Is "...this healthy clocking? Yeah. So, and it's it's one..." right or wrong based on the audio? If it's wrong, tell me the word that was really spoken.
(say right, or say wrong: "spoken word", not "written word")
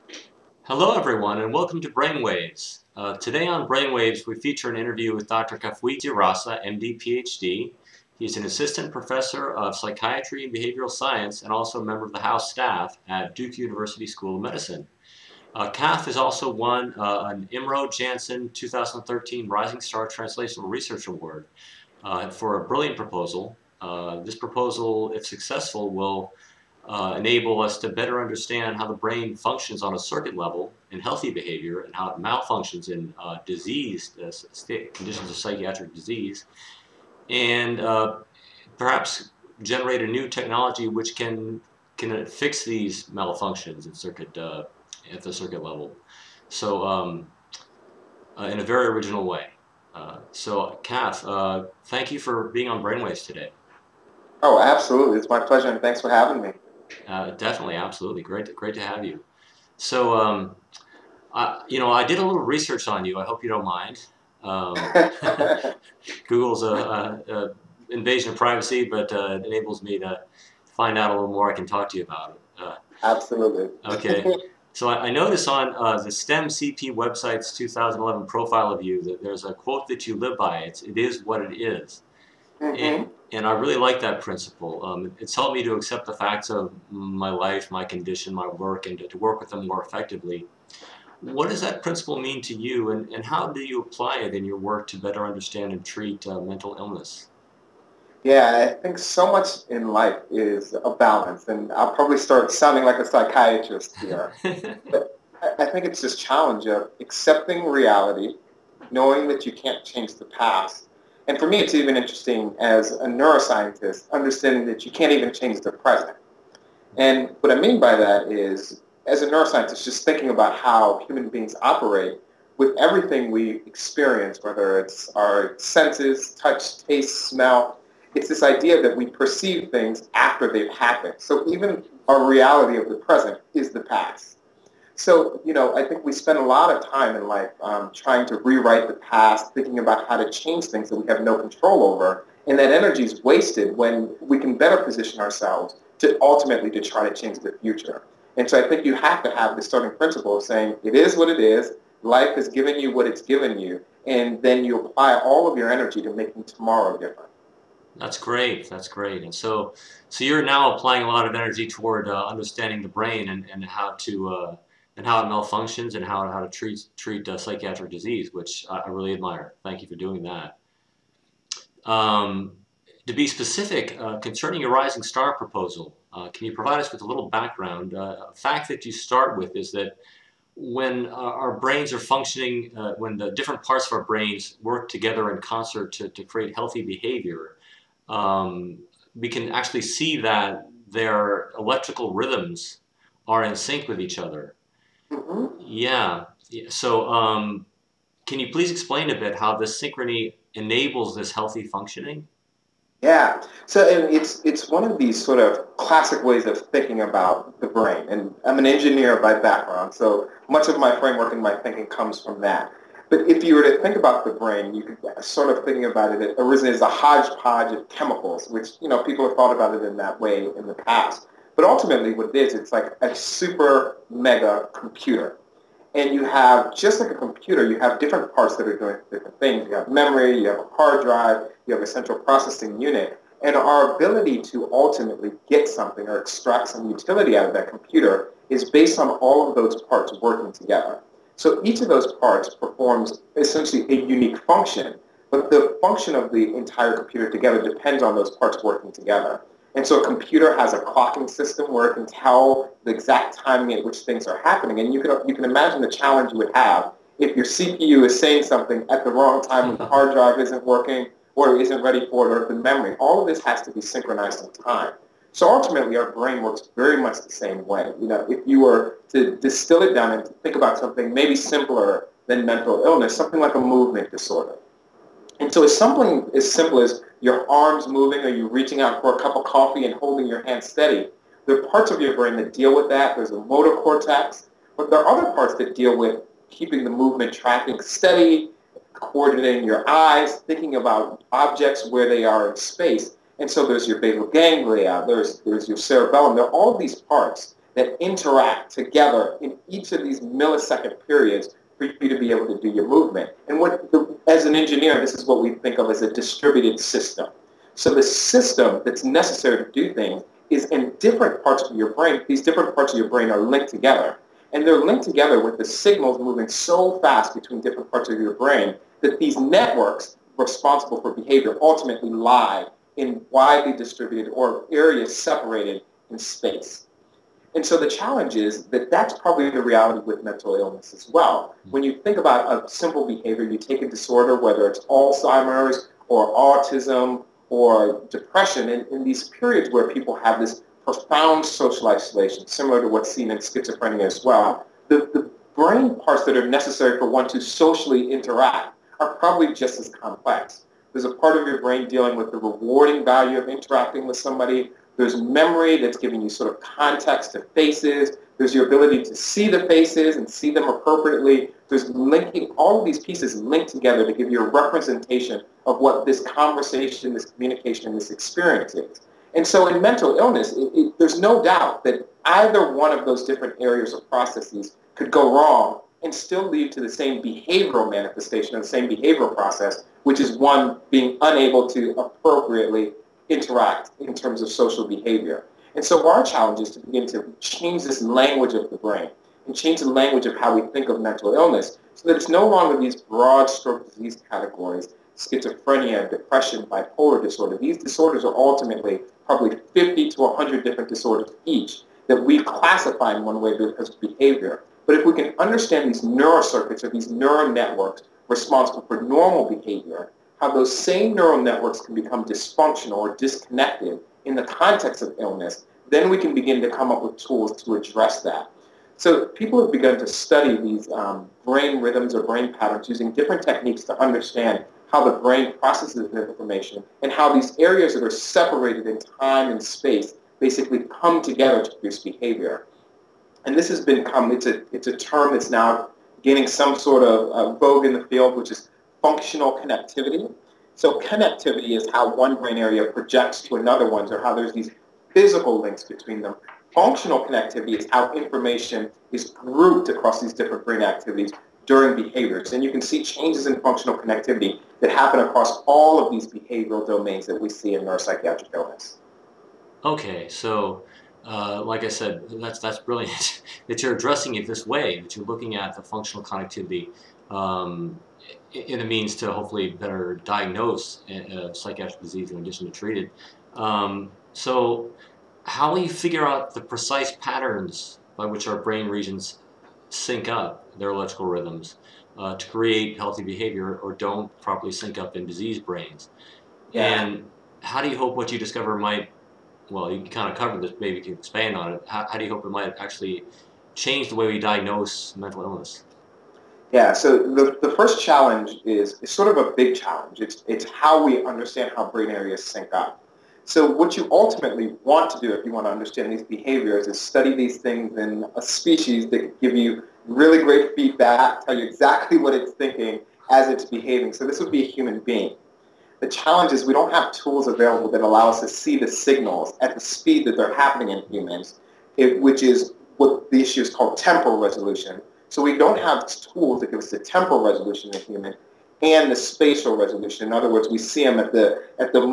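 wrong: "functioning", not "clocking".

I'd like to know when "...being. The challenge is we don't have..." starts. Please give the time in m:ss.
8:34.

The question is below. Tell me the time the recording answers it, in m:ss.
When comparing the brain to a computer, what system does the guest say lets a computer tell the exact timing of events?
4:10.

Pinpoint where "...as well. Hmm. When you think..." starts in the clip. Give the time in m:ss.
5:30.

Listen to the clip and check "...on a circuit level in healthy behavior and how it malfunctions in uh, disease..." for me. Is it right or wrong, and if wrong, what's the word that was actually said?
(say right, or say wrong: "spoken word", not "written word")
right.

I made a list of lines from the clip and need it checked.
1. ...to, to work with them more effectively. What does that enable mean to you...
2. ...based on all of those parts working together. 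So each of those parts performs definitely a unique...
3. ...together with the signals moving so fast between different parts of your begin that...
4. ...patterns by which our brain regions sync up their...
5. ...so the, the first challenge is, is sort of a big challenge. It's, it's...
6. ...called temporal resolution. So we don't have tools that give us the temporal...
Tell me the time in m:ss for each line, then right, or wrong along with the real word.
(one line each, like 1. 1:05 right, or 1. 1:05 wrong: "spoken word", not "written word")
1. 1:28 wrong: "principle", not "enable"
2. 3:58 wrong: "essentially", not "definitely"
3. 5:15 wrong: "brain", not "begin"
4. 7:57 right
5. 8:16 right
6. 8:43 right.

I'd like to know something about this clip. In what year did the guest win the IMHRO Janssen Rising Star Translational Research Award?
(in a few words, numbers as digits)
2013.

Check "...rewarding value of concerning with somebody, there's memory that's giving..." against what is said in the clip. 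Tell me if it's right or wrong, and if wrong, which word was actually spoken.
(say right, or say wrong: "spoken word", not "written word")
wrong: "interacting", not "concerning".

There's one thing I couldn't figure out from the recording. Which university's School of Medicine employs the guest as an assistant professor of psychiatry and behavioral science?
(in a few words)
Duke University.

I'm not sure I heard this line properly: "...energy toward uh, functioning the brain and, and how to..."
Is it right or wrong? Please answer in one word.
wrong.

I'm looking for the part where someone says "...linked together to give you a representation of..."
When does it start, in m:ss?
6:03.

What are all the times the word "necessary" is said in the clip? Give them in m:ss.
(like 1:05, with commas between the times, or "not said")
5:09, 5:46.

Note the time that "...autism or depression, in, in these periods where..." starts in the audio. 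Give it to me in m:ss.
5:36.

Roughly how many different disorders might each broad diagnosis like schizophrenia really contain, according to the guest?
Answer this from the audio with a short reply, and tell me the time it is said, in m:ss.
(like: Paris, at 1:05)
50 to 100, at 6:39.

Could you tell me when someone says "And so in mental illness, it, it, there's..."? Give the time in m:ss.
6:09.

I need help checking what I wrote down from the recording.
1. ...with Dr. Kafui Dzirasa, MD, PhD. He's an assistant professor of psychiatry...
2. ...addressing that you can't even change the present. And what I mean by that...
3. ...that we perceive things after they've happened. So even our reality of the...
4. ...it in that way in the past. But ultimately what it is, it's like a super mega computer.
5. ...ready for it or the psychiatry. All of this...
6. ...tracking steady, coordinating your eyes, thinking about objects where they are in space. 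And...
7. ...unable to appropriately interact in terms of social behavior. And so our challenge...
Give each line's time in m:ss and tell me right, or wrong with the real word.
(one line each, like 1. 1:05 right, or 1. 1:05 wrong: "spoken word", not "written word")
1. 0:05 right
2. 1:54 wrong: "understanding", not "addressing"
3. 2:08 right
4. 3:39 right
5. 4:21 wrong: "memory", not "psychiatry"
6. 4:47 right
7. 6:21 right.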